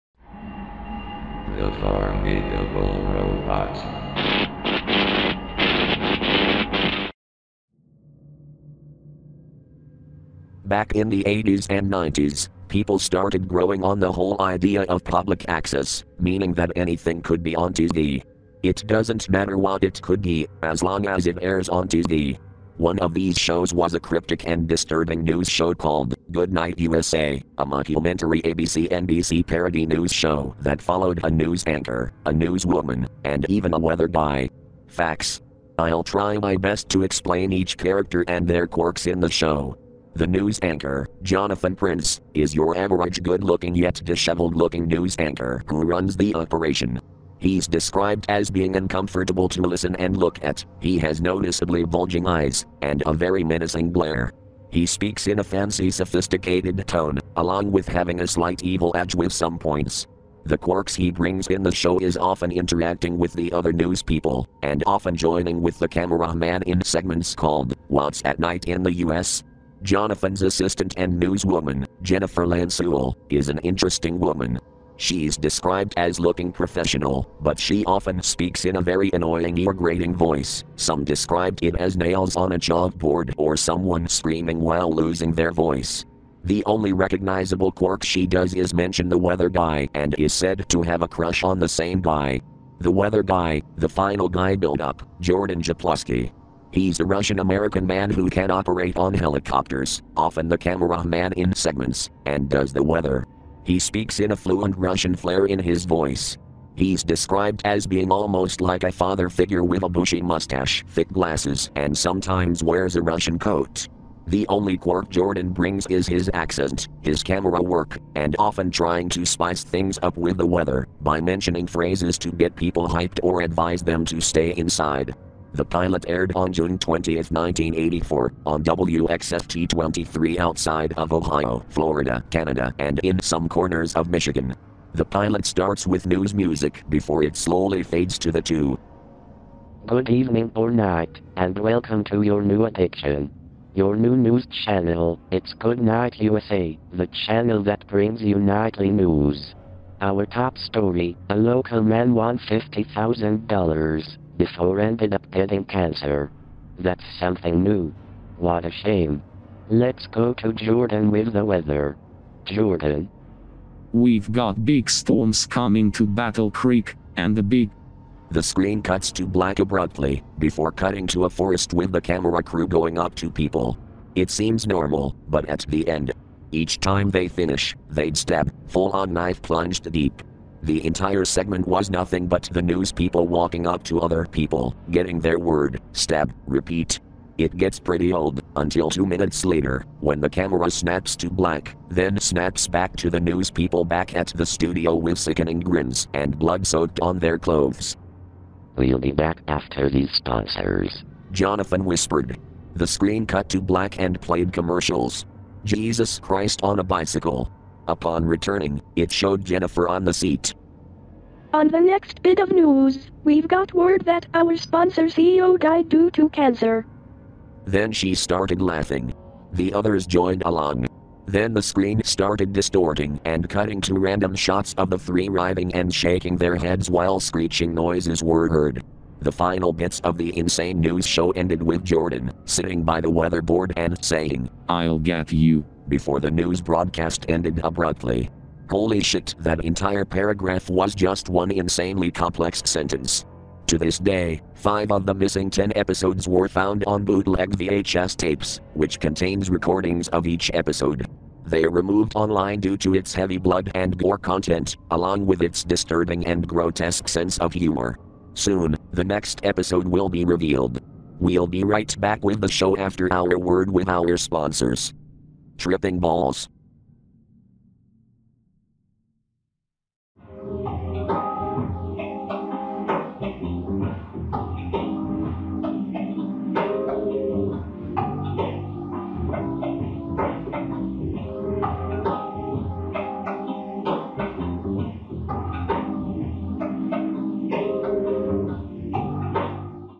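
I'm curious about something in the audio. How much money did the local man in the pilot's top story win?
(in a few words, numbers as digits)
$50,000.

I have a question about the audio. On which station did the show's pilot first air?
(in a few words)
WXFT 23.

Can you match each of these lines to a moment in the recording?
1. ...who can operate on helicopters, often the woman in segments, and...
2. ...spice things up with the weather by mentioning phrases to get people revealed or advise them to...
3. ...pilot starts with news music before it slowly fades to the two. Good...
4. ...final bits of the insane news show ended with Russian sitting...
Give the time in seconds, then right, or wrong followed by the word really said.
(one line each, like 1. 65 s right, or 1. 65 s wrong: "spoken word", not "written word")
1. 98 s wrong: "cameraman", not "woman"
2. 119 s wrong: "hyped", not "revealed"
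3. 135 s right
4. 229 s wrong: "Jordan", not "Russian".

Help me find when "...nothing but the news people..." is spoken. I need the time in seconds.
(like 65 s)
181 s.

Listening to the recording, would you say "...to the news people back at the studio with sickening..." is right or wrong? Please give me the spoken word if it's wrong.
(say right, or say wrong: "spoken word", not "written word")
right.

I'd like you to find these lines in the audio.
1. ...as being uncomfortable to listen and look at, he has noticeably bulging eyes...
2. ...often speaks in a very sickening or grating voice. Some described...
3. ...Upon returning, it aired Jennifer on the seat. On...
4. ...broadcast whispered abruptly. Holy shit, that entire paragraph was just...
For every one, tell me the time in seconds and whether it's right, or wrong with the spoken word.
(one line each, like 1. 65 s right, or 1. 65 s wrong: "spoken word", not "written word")
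1. 48 s right
2. 77 s wrong: "annoying", not "sickening"
3. 207 s wrong: "showed", not "aired"
4. 236 s wrong: "ended", not "whispered".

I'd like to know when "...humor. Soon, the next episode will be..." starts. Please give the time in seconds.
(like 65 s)
257 s.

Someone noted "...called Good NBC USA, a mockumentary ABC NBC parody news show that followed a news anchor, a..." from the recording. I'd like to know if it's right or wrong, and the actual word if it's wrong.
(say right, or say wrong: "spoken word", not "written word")
wrong: "Night", not "NBC".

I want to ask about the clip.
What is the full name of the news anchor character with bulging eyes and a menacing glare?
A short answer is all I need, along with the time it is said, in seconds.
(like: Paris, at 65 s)
Jonathan Prince, at 41 s.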